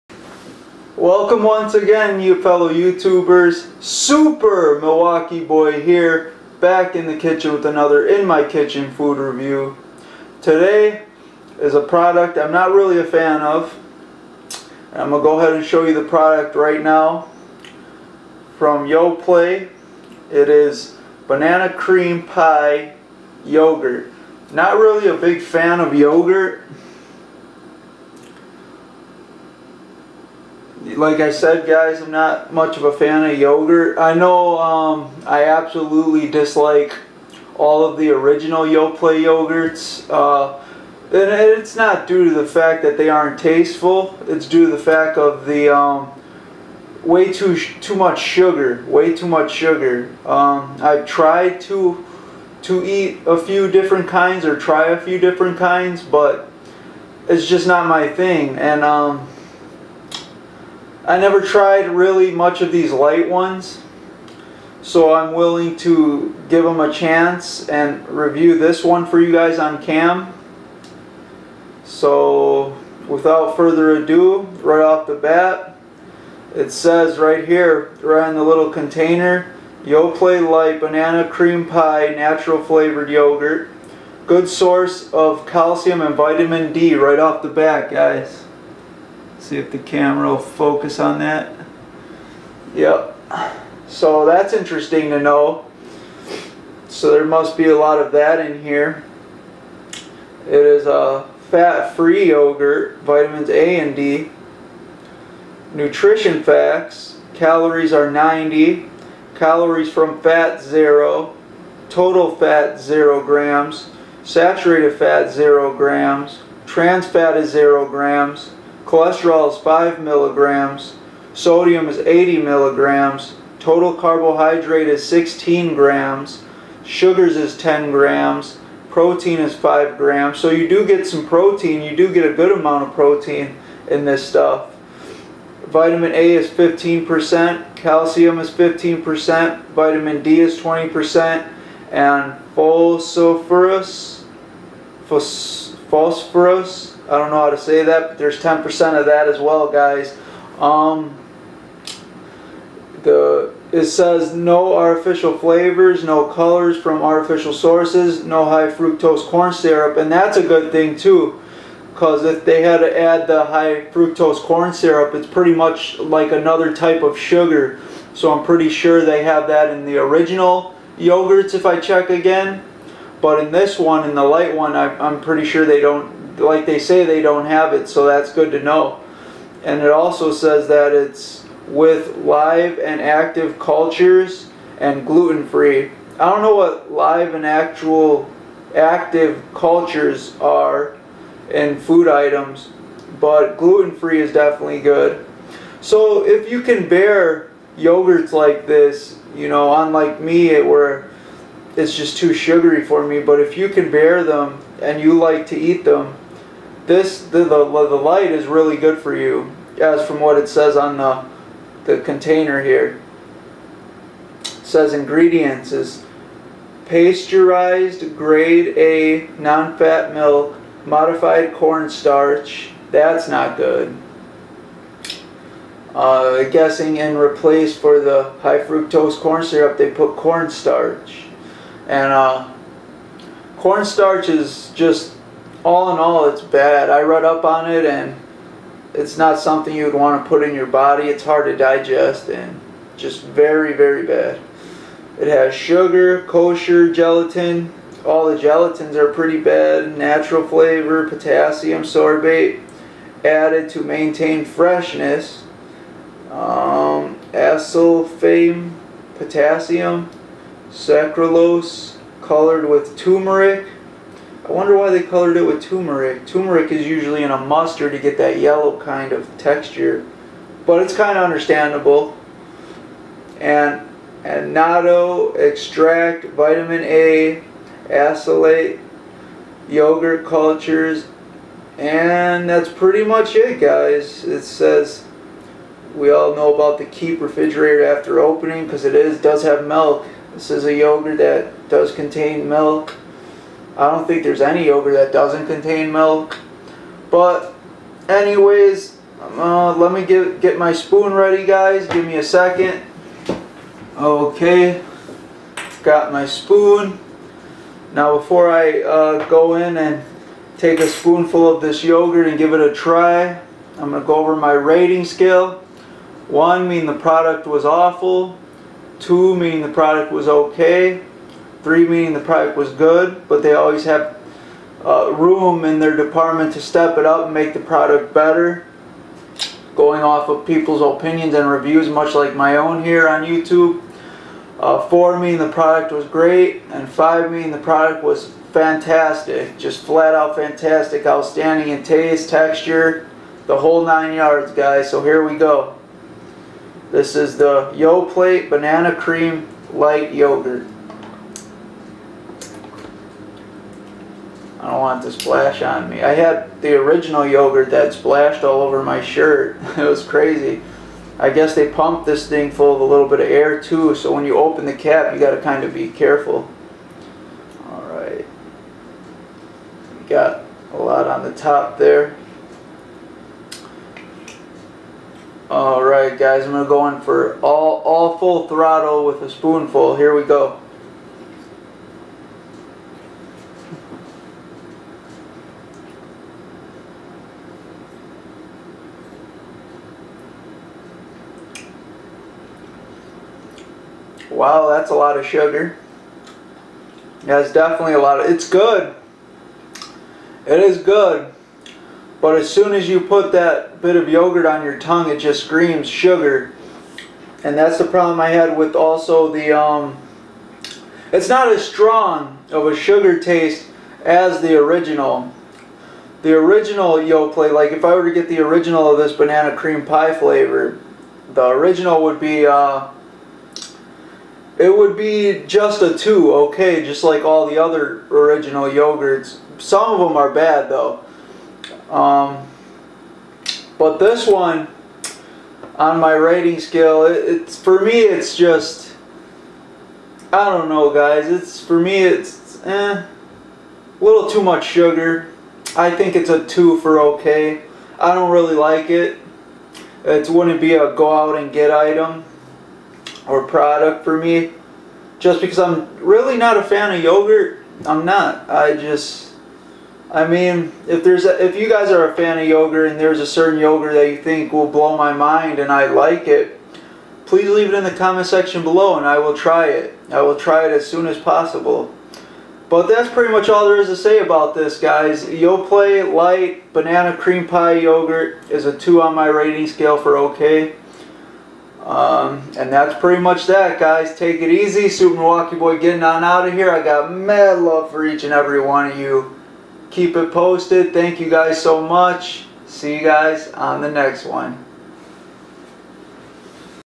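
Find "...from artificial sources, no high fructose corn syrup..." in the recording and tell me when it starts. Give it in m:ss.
2:36.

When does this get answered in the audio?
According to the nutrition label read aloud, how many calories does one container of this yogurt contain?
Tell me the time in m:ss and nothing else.
1:48.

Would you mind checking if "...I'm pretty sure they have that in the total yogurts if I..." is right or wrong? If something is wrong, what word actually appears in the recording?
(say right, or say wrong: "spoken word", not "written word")
wrong: "original", not "total".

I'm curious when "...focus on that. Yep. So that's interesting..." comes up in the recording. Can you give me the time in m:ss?
1:30.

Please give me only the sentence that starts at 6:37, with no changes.
That's definitely a lot of, it's good.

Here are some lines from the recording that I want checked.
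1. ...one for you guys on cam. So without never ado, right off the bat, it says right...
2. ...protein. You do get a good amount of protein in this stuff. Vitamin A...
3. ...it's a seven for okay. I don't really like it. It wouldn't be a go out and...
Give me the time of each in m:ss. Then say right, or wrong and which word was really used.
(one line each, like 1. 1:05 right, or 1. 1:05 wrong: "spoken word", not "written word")
1. 1:08 wrong: "further", not "never"
2. 2:11 right
3. 7:26 wrong: "two", not "seven".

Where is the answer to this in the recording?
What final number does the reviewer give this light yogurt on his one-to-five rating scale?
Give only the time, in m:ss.
7:58.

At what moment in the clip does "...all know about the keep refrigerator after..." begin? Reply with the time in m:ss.
4:46.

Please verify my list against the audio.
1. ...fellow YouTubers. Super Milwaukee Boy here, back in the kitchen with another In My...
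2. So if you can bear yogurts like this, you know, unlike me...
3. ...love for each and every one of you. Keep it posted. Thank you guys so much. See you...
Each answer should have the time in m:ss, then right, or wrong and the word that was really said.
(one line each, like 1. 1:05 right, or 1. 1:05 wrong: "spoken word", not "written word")
1. 0:02 right
2. 3:15 right
3. 8:07 right.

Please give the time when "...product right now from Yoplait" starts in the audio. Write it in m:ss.
0:16.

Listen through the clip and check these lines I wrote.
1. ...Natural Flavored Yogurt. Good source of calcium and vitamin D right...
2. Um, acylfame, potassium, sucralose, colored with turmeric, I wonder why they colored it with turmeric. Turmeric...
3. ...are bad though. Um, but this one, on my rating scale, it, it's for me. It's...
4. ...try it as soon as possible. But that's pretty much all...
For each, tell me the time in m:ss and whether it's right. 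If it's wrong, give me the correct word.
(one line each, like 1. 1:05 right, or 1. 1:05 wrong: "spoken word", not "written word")
1. 1:22 right
2. 4:16 right
3. 7:10 right
4. 7:50 right.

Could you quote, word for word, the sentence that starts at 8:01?
Um, and that's pretty much that, guys.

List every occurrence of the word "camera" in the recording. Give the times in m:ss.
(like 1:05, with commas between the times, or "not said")
1:29.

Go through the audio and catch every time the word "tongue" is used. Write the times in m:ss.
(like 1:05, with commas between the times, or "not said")
6:44.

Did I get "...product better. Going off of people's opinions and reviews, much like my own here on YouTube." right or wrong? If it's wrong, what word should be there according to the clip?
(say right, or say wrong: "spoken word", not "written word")
right.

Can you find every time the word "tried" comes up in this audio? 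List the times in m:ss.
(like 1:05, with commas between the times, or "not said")
0:51, 1:01.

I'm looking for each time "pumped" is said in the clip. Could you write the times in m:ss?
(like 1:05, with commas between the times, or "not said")
6:01.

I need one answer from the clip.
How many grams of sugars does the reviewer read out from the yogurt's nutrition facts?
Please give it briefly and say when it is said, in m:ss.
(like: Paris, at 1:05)
10 grams, at 2:07.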